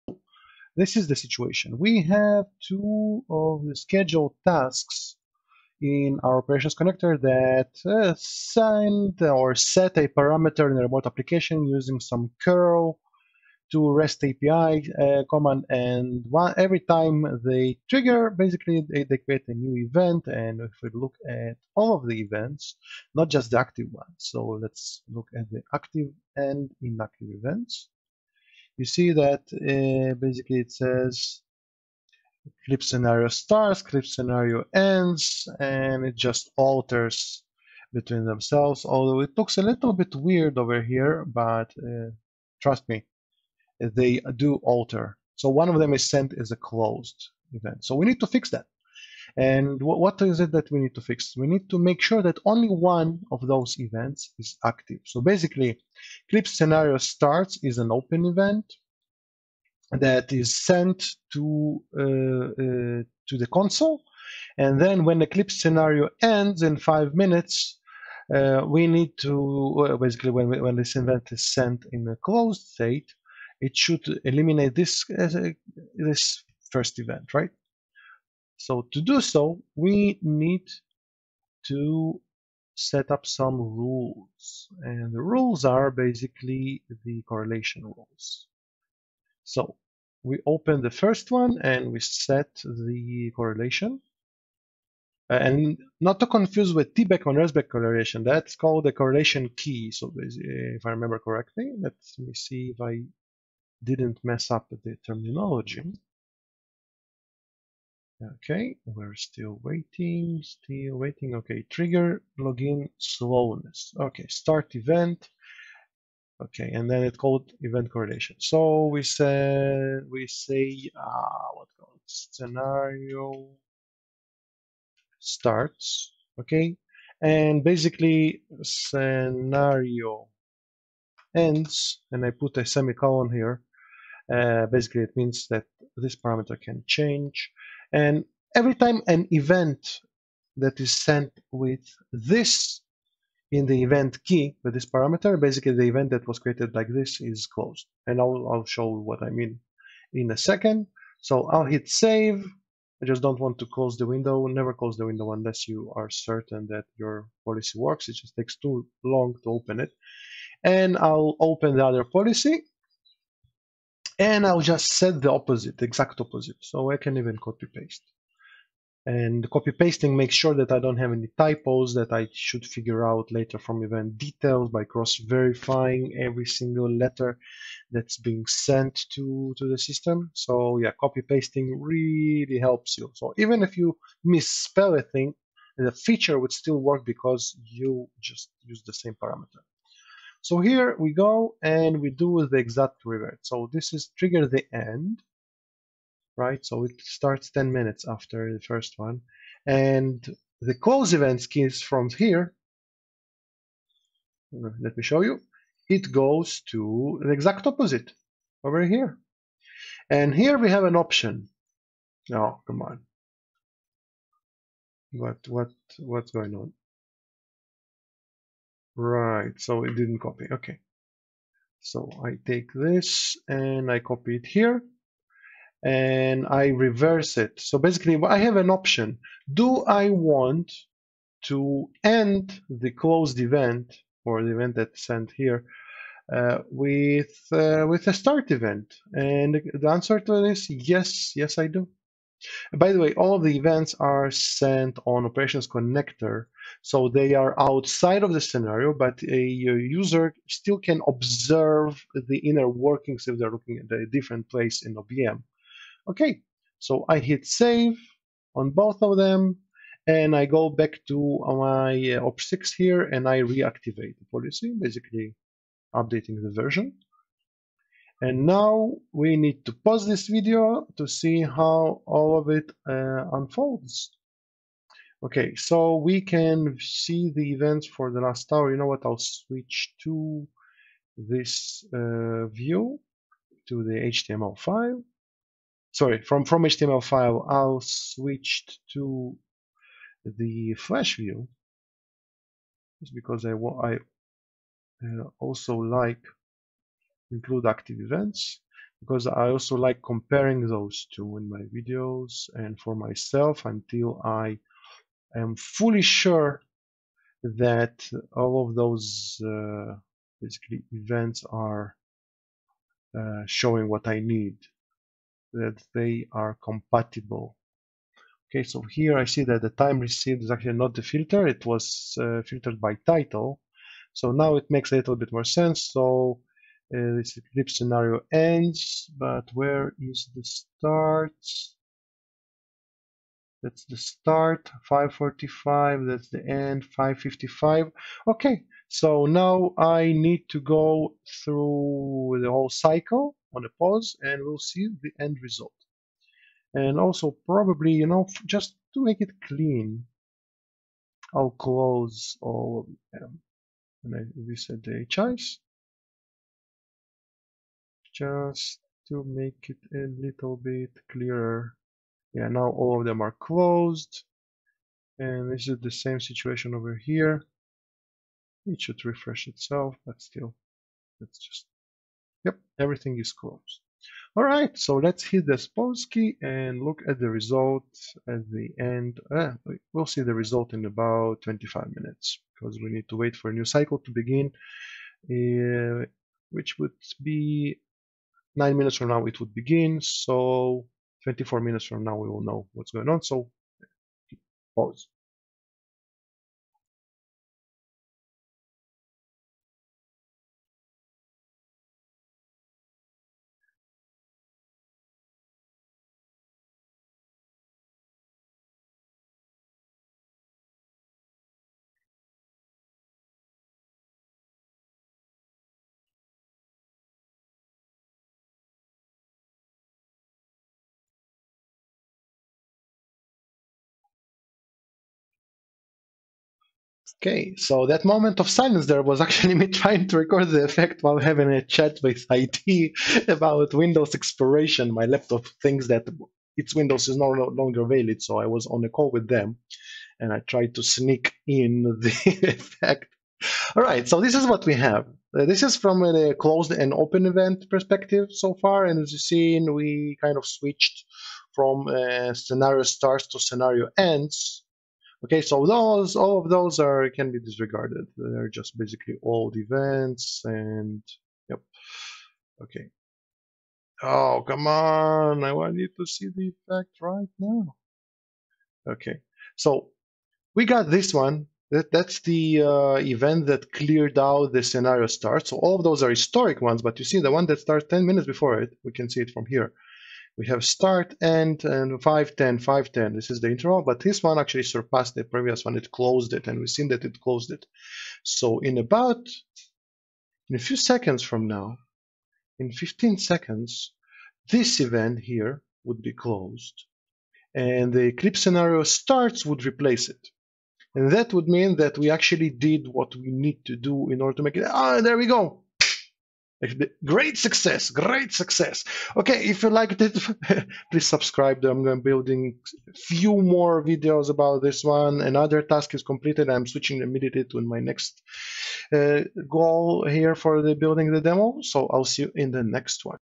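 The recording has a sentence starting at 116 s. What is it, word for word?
Okay, and then it called event correlation.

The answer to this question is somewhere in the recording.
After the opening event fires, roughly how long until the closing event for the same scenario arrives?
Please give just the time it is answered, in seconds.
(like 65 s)
66 s.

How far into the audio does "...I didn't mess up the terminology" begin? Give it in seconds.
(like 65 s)
102 s.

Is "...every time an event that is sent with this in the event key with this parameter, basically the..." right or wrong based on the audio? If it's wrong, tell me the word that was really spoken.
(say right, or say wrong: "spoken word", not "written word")
right.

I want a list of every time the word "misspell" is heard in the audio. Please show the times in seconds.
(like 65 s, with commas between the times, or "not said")
184 s.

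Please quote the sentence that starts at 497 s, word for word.
And the eclipse scenario starts would replace it.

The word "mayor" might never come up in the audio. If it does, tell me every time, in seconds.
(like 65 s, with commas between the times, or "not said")
not said.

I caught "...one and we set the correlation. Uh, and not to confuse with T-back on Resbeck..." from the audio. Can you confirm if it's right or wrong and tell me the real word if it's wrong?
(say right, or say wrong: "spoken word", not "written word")
right.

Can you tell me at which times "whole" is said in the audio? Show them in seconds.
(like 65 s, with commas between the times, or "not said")
342 s.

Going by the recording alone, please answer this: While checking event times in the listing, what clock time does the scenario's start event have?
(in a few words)
5:45.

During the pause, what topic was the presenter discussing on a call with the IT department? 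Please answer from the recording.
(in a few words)
Windows expiration.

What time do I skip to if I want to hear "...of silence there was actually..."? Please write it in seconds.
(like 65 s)
428 s.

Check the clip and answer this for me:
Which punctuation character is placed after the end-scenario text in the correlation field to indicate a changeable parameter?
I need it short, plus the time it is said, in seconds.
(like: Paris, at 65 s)
semicolon, at 132 s.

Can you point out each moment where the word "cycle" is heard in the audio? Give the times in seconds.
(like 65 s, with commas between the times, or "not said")
342 s, 383 s.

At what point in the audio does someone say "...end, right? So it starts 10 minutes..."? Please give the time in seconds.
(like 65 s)
194 s.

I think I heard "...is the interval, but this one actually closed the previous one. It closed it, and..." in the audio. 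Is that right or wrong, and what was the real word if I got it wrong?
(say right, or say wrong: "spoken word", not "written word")
wrong: "surpassed", not "closed".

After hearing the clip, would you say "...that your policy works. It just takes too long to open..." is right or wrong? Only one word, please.
right.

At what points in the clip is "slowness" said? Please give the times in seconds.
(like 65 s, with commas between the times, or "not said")
112 s.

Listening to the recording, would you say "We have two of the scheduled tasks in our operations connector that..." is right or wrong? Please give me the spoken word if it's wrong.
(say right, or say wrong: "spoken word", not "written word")
right.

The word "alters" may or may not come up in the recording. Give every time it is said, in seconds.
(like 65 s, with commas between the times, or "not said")
36 s, 44 s.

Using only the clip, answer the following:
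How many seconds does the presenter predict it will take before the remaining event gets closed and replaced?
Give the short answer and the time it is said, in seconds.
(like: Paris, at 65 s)
15, at 492 s.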